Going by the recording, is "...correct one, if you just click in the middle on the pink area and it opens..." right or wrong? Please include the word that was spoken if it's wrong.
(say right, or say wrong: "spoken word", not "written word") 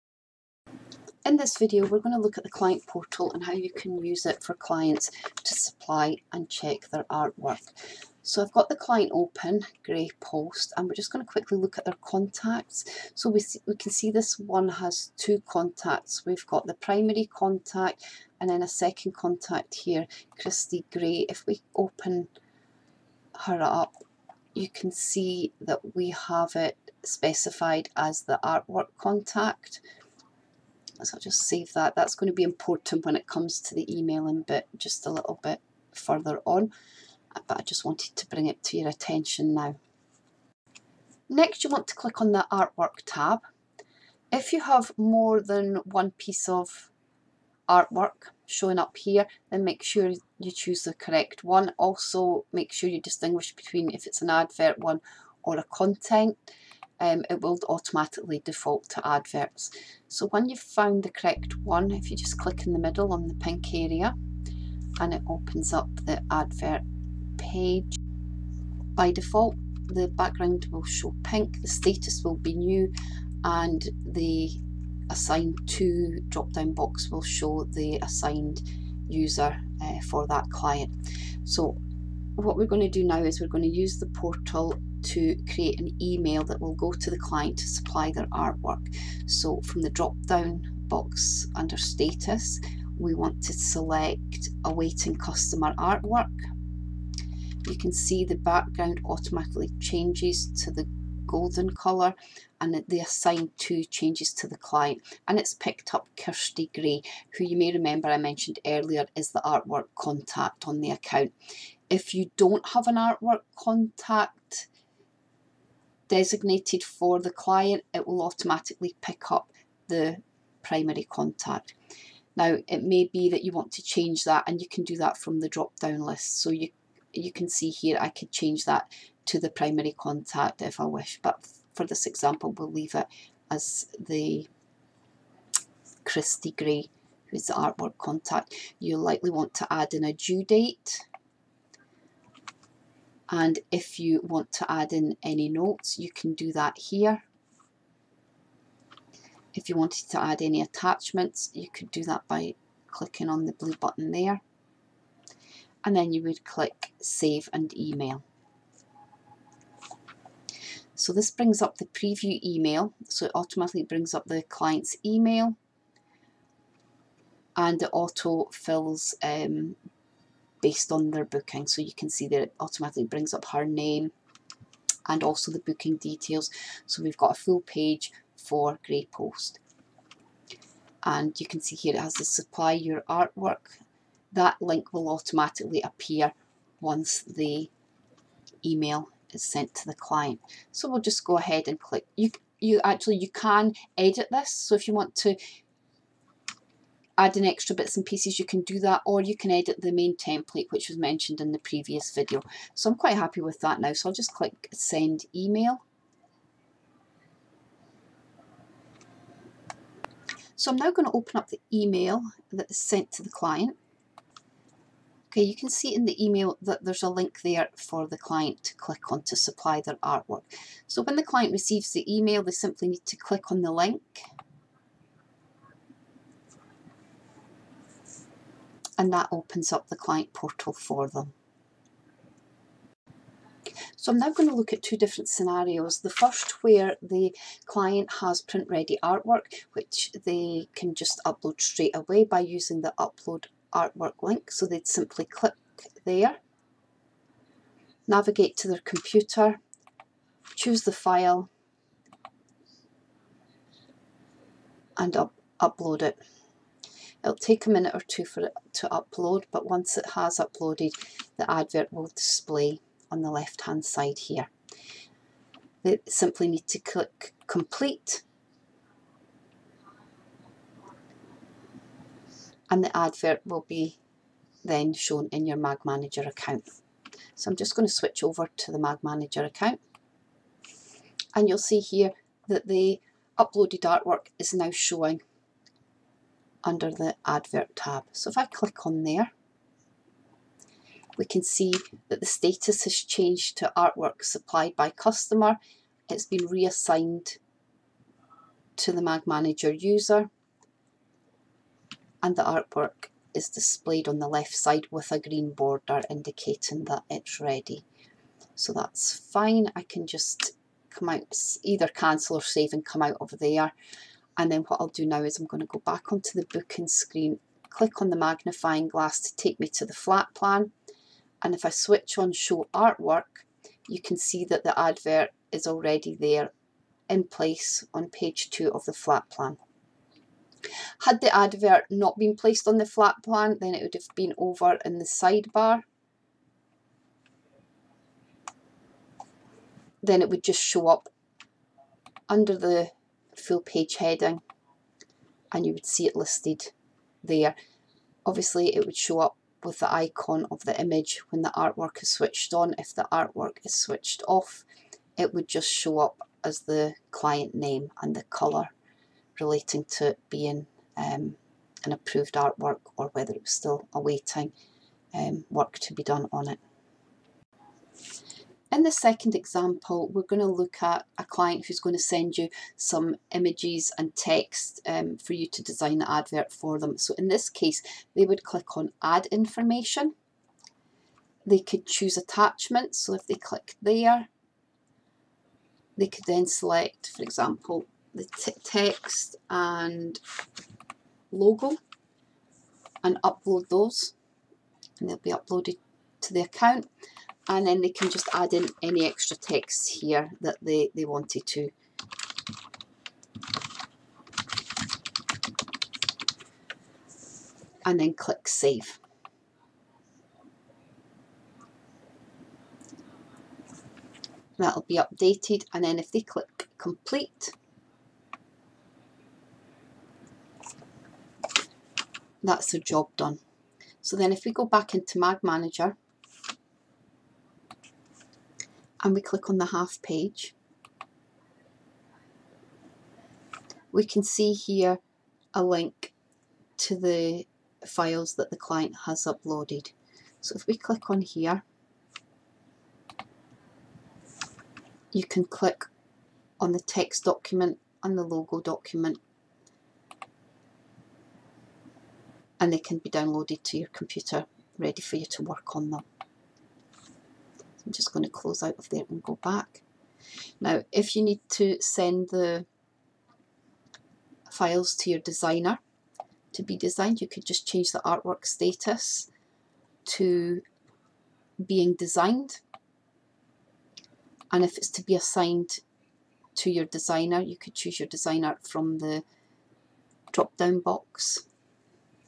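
right.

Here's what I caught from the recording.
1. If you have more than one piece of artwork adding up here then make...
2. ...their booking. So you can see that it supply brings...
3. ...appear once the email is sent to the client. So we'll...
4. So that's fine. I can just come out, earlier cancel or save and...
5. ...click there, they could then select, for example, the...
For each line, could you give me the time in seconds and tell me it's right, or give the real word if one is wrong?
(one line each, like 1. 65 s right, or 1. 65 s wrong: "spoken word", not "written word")
1. 44 s wrong: "showing", not "adding"
2. 171 s wrong: "automatically", not "supply"
3. 185 s right
4. 308 s wrong: "either", not "earlier"
5. 383 s right.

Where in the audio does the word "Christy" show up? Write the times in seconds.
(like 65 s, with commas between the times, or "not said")
20 s, 136 s.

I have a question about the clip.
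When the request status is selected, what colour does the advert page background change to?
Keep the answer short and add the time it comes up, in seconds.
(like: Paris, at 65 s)
Golden, at 101 s.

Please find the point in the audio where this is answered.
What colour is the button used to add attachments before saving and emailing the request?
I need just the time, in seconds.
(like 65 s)
153 s.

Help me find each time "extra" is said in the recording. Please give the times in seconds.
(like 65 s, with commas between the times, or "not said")
197 s, 399 s.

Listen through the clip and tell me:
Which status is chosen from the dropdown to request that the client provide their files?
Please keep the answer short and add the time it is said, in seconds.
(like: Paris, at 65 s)
Awaiting customer artwork, at 94 s.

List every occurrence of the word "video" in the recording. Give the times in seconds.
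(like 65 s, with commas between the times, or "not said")
1 s, 202 s.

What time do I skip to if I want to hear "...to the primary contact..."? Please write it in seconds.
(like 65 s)
129 s.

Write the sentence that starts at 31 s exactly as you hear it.
That's going to be important when it comes to the emailing bit just a little bit further on.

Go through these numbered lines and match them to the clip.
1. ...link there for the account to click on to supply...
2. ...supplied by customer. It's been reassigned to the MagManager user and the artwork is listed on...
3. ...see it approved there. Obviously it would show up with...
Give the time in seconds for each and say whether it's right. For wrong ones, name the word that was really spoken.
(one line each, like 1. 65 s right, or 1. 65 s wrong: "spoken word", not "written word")
1. 217 s wrong: "client", not "account"
2. 294 s wrong: "displayed", not "listed"
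3. 345 s wrong: "listed", not "approved".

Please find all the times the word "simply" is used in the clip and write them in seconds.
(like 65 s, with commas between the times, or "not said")
222 s, 244 s, 266 s.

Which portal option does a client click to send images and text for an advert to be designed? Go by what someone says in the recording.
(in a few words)
Add Information.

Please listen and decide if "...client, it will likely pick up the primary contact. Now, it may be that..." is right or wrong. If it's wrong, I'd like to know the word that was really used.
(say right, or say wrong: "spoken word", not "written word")
wrong: "automatically", not "likely".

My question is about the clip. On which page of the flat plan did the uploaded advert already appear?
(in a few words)
Page 2.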